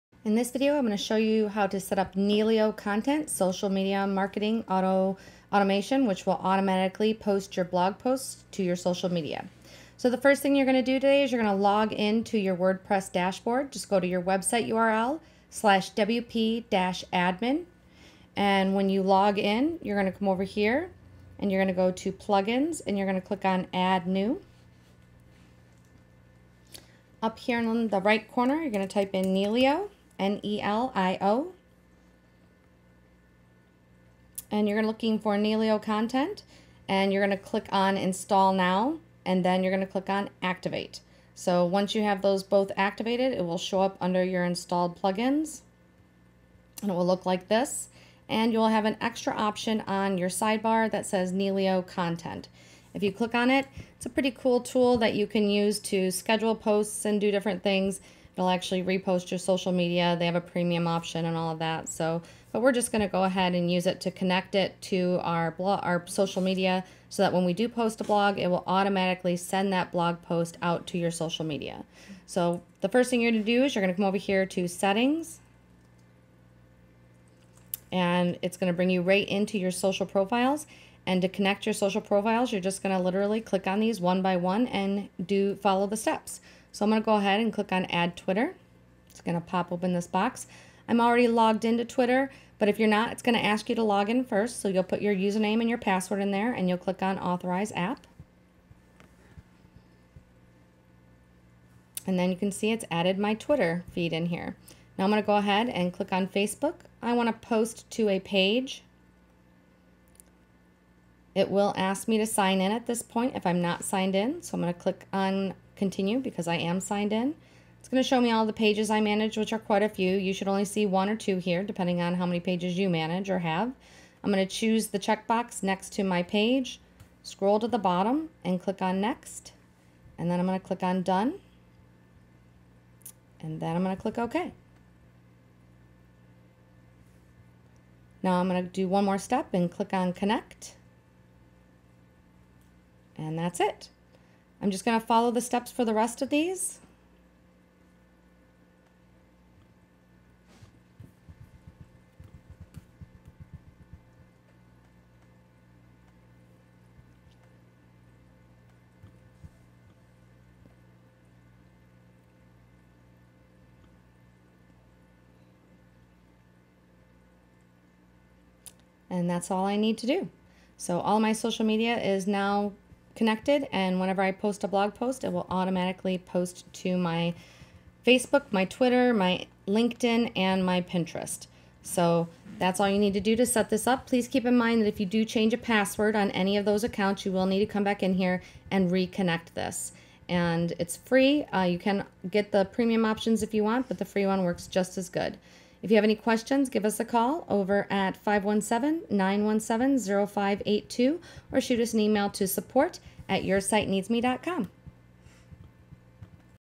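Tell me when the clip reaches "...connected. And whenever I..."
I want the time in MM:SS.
02:53.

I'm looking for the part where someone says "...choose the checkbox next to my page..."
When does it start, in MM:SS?
02:04.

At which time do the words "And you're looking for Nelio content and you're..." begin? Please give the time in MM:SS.
00:34.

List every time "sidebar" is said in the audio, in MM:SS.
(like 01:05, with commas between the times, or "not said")
00:50.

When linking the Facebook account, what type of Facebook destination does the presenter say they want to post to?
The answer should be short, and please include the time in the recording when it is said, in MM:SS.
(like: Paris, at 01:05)
a page, at 01:48.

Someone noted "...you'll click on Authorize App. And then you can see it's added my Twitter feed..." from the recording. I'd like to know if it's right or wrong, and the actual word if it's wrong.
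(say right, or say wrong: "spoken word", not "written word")
right.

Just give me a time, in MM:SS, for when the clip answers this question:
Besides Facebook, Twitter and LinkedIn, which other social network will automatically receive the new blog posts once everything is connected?
03:00.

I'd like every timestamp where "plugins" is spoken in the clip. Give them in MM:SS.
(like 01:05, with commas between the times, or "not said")
00:22, 00:45.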